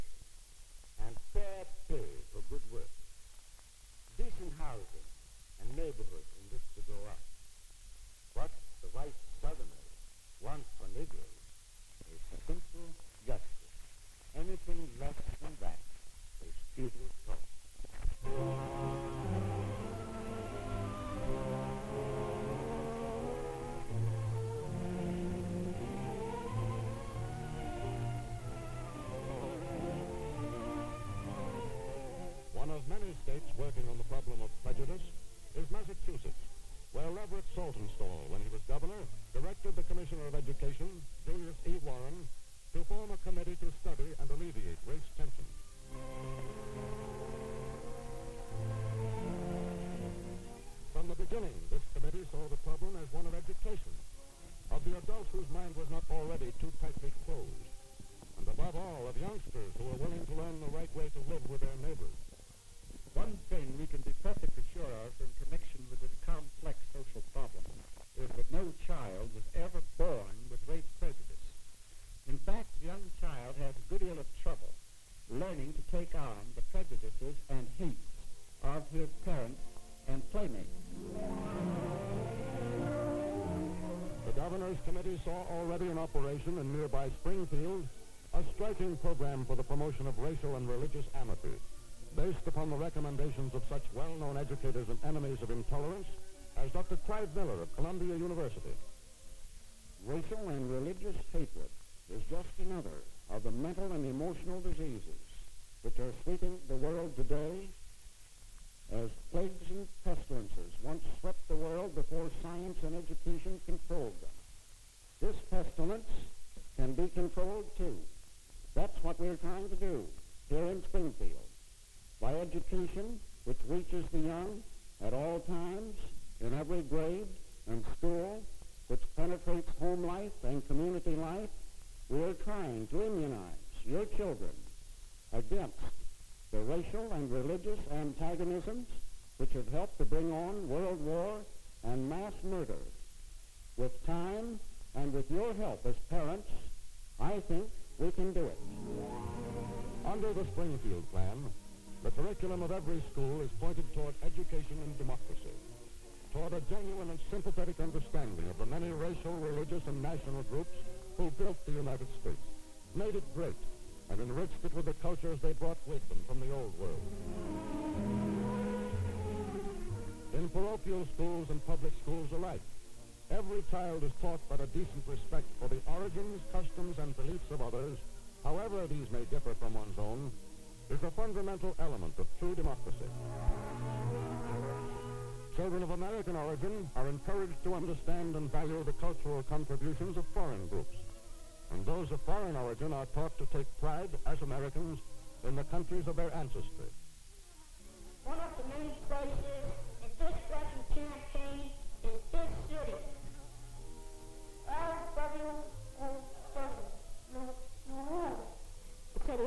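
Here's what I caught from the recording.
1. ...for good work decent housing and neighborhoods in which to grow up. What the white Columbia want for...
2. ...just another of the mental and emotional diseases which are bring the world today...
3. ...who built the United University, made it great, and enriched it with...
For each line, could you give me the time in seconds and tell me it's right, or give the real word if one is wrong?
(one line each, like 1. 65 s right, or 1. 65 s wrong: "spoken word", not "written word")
1. 2 s wrong: "Southerners", not "Columbia"
2. 102 s wrong: "sweeping", not "bring"
3. 161 s wrong: "States", not "University".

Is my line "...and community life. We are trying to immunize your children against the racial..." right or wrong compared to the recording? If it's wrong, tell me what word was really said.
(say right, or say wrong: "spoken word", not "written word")
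right.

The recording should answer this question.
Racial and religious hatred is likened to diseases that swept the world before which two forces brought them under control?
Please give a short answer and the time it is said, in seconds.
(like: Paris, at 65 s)
science and education, at 112 s.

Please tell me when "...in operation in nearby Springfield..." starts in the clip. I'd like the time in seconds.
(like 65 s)
85 s.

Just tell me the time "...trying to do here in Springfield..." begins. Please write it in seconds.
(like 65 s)
119 s.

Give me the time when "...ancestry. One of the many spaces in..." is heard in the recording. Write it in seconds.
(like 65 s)
196 s.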